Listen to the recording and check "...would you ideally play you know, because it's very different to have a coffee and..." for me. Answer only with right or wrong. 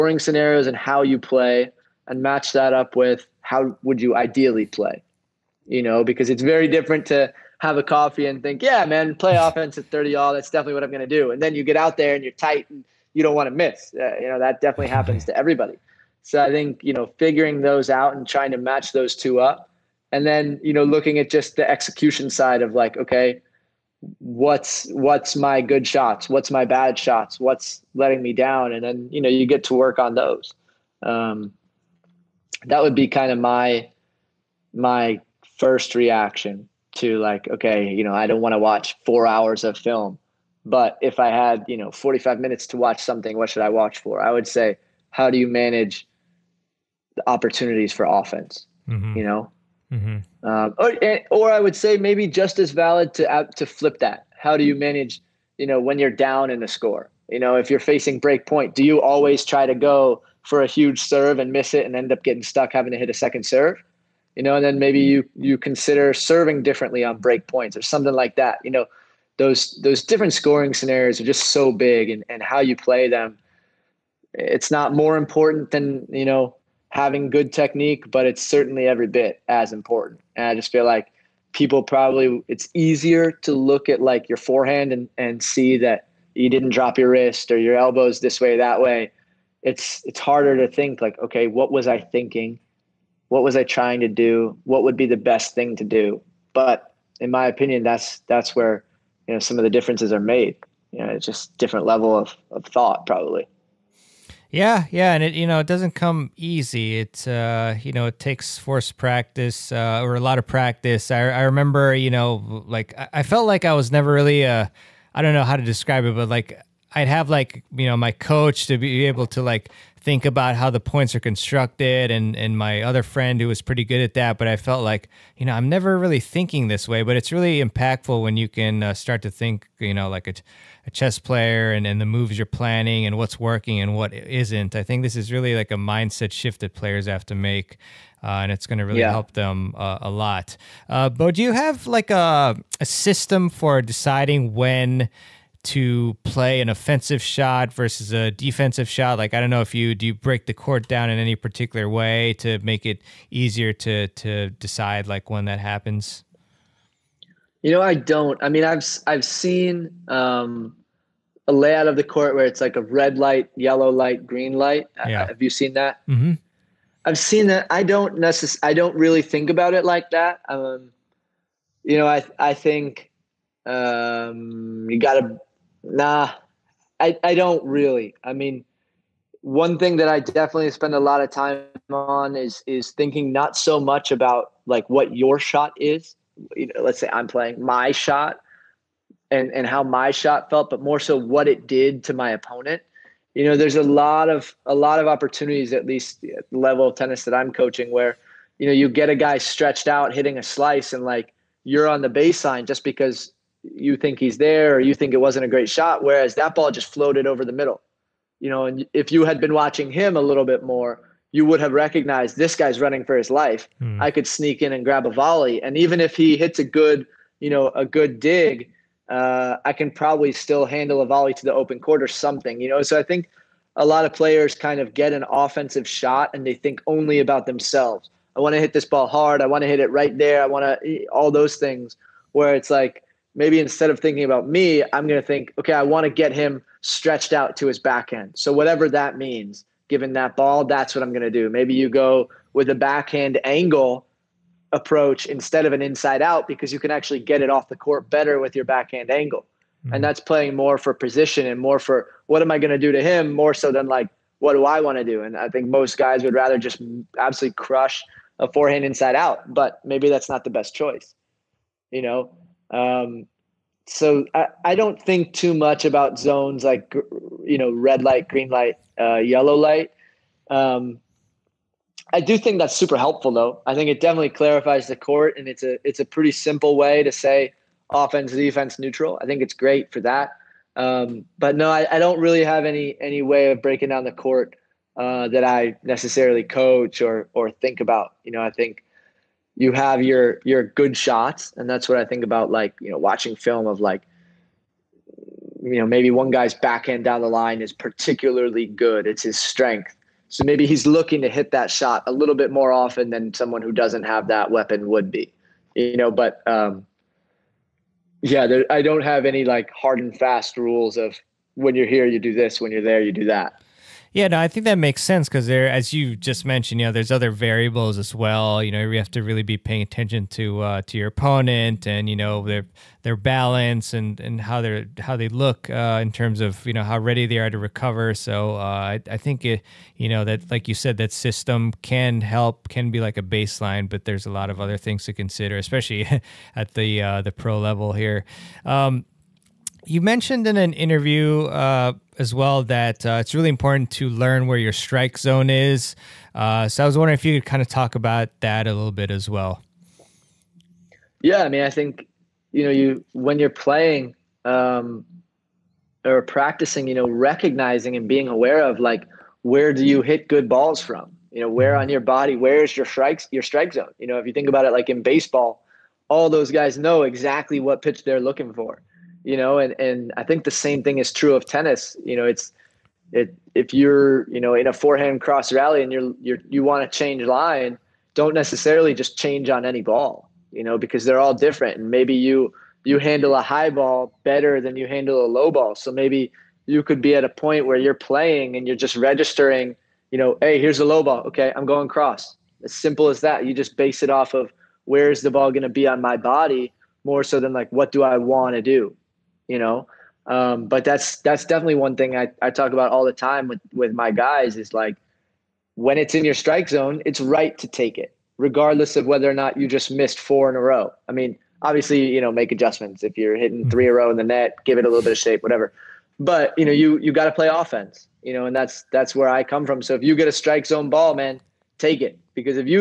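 right.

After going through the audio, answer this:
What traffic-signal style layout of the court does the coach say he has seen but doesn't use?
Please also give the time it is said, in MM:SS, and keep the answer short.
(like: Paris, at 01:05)
Red light, yellow light, green light, at 02:42.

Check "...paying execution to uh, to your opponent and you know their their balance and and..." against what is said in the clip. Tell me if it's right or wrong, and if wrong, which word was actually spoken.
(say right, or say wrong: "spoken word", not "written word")
wrong: "attention", not "execution".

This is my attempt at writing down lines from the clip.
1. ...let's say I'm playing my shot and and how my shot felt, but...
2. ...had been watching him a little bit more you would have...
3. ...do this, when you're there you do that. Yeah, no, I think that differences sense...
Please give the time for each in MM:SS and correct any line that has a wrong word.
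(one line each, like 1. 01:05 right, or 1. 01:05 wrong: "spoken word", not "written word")
1. 03:06 right
2. 03:29 right
3. 05:12 wrong: "makes", not "differences".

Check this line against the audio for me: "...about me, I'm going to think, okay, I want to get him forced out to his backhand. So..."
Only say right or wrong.
wrong.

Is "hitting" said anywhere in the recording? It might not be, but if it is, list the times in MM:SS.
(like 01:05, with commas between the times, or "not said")
03:20, 06:53.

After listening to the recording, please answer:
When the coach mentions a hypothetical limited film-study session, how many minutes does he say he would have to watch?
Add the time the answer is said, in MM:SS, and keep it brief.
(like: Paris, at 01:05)
45, at 00:41.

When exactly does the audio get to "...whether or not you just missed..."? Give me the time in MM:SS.
06:49.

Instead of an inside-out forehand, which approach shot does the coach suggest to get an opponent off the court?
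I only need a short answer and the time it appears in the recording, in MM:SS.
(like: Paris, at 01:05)
Backhand angle approach, at 04:02.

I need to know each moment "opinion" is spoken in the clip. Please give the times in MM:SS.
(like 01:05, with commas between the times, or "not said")
01:37.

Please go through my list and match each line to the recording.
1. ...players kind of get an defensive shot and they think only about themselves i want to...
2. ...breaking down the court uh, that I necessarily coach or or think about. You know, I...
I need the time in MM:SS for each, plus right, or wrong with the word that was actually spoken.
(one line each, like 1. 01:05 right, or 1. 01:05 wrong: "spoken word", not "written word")
1. 03:44 wrong: "offensive", not "defensive"
2. 04:43 right.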